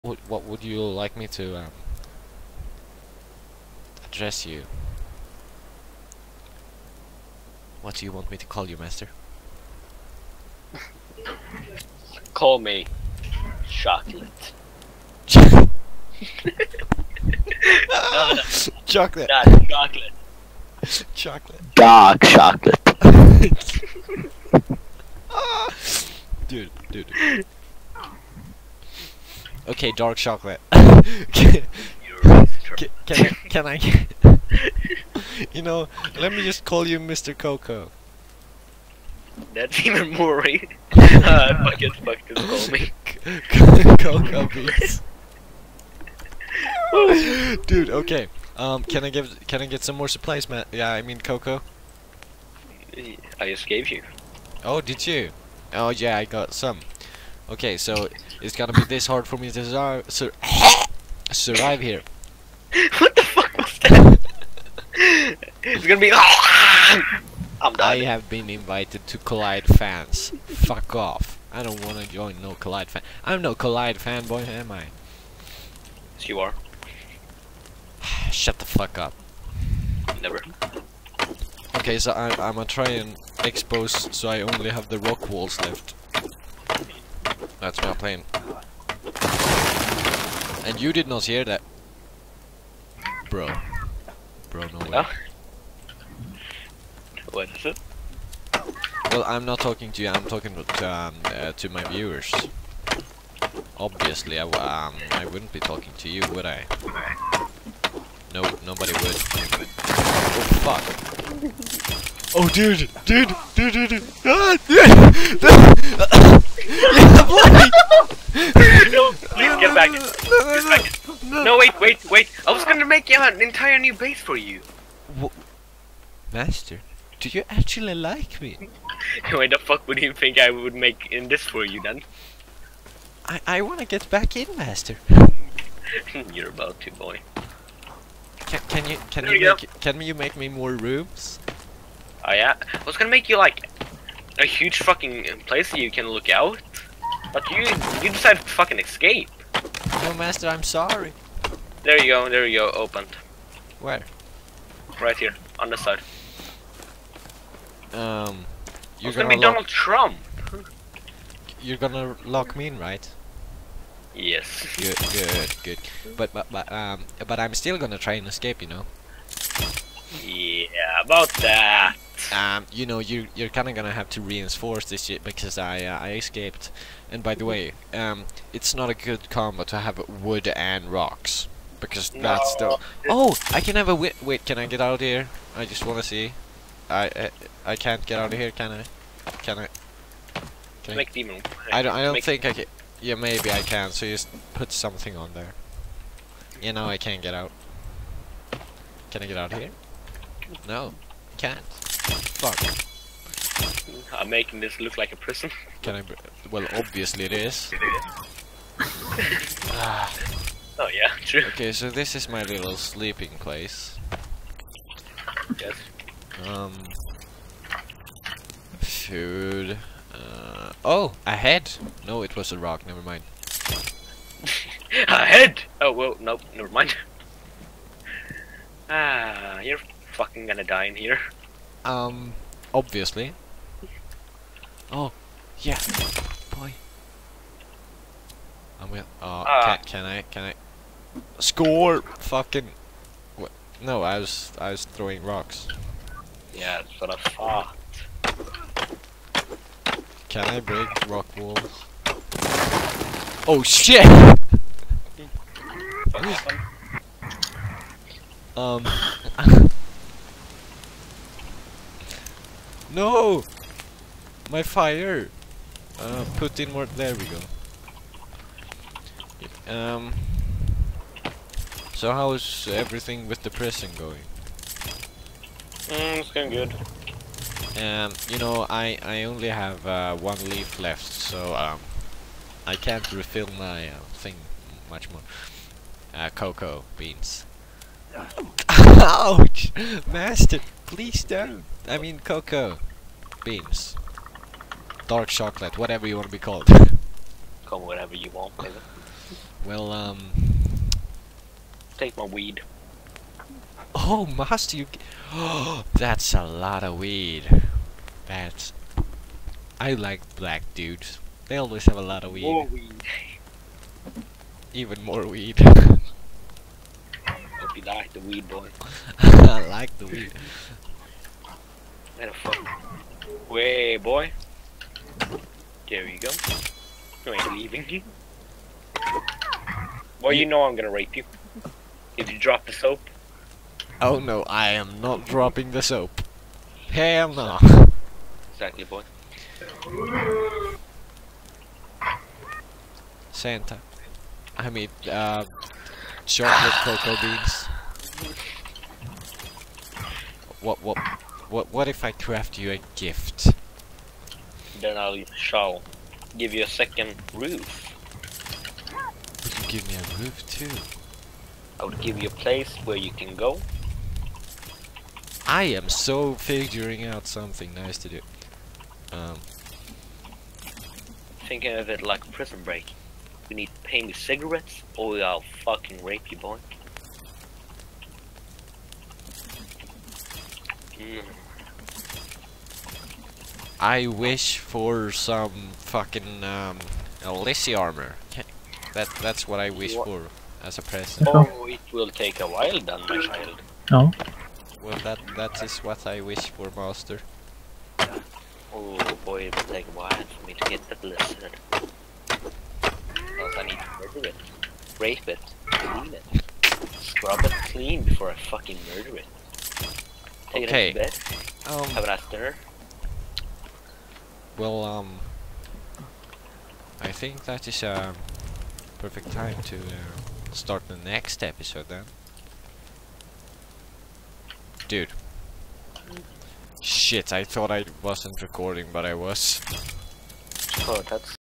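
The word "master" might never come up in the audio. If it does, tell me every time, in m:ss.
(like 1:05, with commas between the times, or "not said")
0:08, 2:06, 2:14, 2:30, 4:50, 5:04, 6:36.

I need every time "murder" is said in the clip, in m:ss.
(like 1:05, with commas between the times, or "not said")
6:44, 6:48.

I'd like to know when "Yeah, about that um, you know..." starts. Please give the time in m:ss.
2:50.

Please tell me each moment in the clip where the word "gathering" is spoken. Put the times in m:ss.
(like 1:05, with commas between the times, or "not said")
not said.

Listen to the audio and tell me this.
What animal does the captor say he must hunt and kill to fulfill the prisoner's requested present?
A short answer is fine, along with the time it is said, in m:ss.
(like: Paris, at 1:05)
lizard, at 6:41.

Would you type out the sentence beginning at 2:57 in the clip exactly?
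And by the way, um, it's not a good combo to have wood and rocks.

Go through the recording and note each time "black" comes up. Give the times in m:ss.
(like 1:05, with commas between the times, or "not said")
5:10.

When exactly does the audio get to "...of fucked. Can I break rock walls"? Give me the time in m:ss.
4:07.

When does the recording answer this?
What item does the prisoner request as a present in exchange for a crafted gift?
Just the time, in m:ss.
6:27.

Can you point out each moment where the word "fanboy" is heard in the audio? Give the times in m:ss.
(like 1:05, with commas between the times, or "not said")
1:13.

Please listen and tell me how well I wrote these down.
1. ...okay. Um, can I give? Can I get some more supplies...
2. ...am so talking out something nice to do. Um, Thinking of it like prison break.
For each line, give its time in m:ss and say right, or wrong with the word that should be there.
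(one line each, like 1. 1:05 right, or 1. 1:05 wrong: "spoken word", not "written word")
1. 0:47 right
2. 6:05 wrong: "figuring", not "talking".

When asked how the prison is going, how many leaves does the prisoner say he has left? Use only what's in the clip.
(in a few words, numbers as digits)
1.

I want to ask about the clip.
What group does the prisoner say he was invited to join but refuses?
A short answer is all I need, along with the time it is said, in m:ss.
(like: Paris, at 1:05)
Collide fans, at 1:09.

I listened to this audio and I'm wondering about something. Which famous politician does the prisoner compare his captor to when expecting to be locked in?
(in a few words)
Donald Trump.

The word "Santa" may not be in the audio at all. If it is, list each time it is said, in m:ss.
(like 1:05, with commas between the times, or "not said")
5:43.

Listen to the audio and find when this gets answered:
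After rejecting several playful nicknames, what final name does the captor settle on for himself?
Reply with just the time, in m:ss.
0:44.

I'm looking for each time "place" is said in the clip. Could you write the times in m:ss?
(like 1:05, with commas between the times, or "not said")
2:25, 3:33, 6:02.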